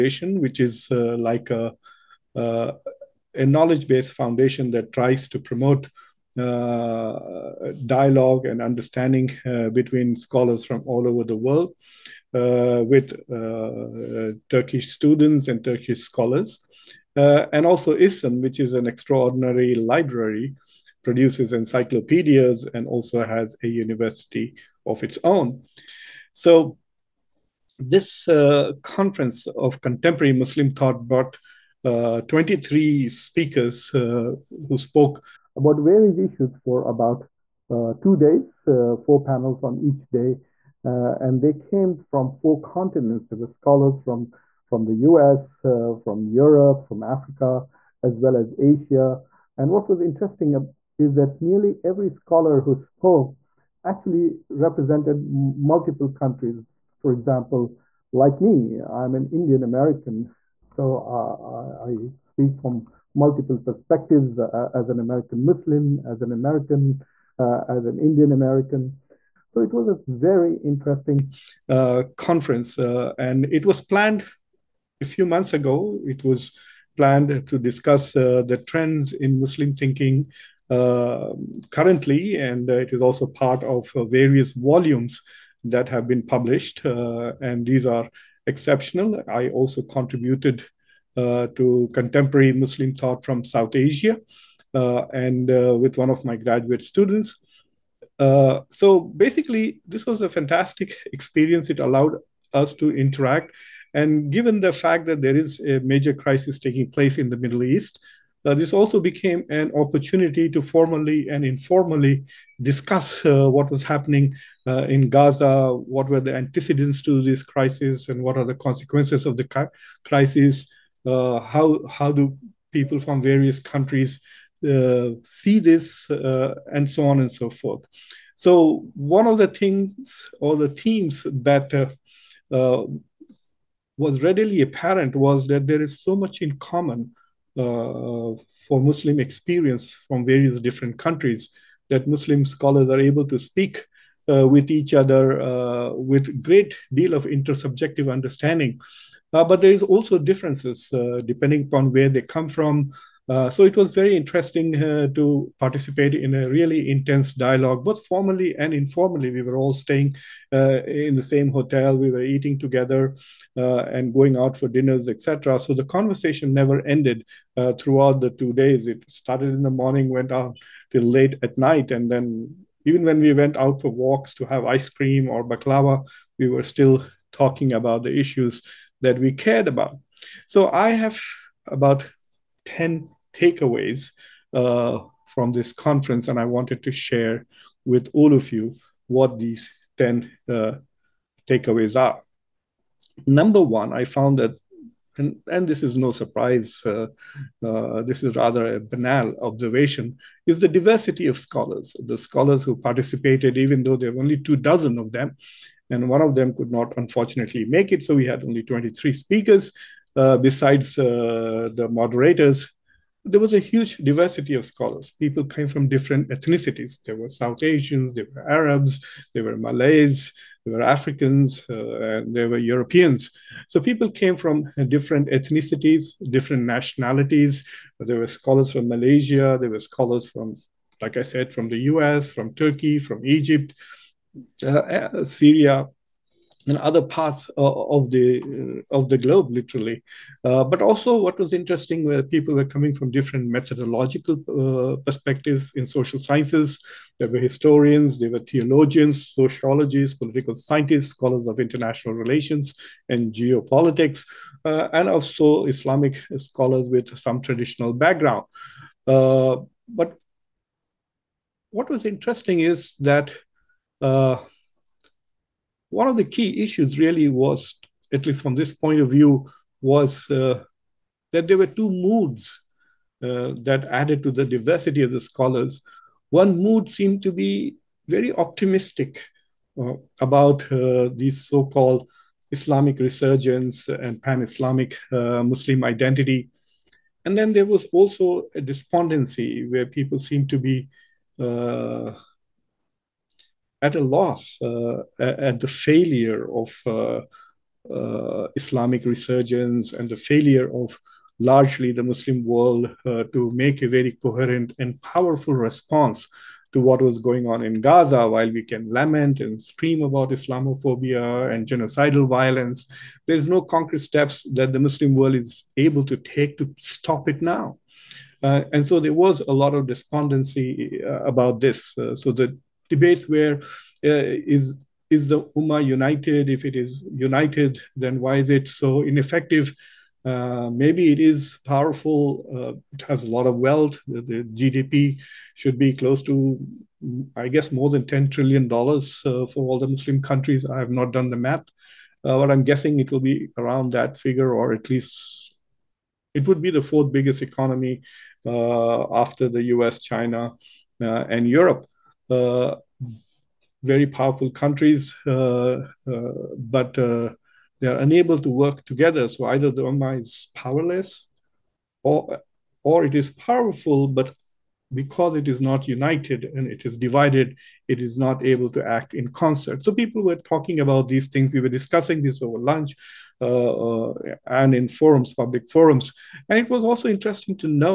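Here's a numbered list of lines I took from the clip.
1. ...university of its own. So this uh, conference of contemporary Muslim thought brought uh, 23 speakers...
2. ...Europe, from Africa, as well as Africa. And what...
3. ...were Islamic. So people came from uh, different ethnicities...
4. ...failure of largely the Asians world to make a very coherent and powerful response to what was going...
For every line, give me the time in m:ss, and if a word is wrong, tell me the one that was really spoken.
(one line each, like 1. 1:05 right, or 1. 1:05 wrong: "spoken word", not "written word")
1. 0:23 right
2. 0:46 wrong: "Asia", not "Africa"
3. 3:42 wrong: "Europeans", not "Islamic"
4. 5:00 wrong: "Muslim", not "Asians".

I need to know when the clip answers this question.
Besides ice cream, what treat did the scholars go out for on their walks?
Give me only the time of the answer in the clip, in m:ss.
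2:55.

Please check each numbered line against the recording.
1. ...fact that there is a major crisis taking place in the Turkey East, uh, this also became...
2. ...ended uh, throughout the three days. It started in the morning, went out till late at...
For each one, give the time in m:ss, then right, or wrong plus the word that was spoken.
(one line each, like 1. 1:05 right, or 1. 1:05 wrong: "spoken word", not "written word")
1. 1:44 wrong: "Middle", not "Turkey"
2. 2:46 wrong: "two", not "three".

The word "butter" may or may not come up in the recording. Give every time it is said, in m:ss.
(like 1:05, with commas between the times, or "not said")
not said.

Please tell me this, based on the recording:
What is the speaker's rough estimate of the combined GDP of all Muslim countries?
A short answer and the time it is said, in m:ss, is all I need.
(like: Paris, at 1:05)
$10 trillion, at 5:38.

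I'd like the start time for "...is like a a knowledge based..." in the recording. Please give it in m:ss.
0:00.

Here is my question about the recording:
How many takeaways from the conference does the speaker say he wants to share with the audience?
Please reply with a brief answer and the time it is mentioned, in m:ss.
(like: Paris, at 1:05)
10, at 3:02.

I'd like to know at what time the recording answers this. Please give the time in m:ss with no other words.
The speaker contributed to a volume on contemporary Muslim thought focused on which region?
1:33.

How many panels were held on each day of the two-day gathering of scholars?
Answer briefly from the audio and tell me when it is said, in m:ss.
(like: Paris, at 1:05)
4, at 0:38.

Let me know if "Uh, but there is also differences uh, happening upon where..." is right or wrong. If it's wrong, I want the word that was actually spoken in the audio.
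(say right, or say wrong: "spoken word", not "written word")
wrong: "depending", not "happening".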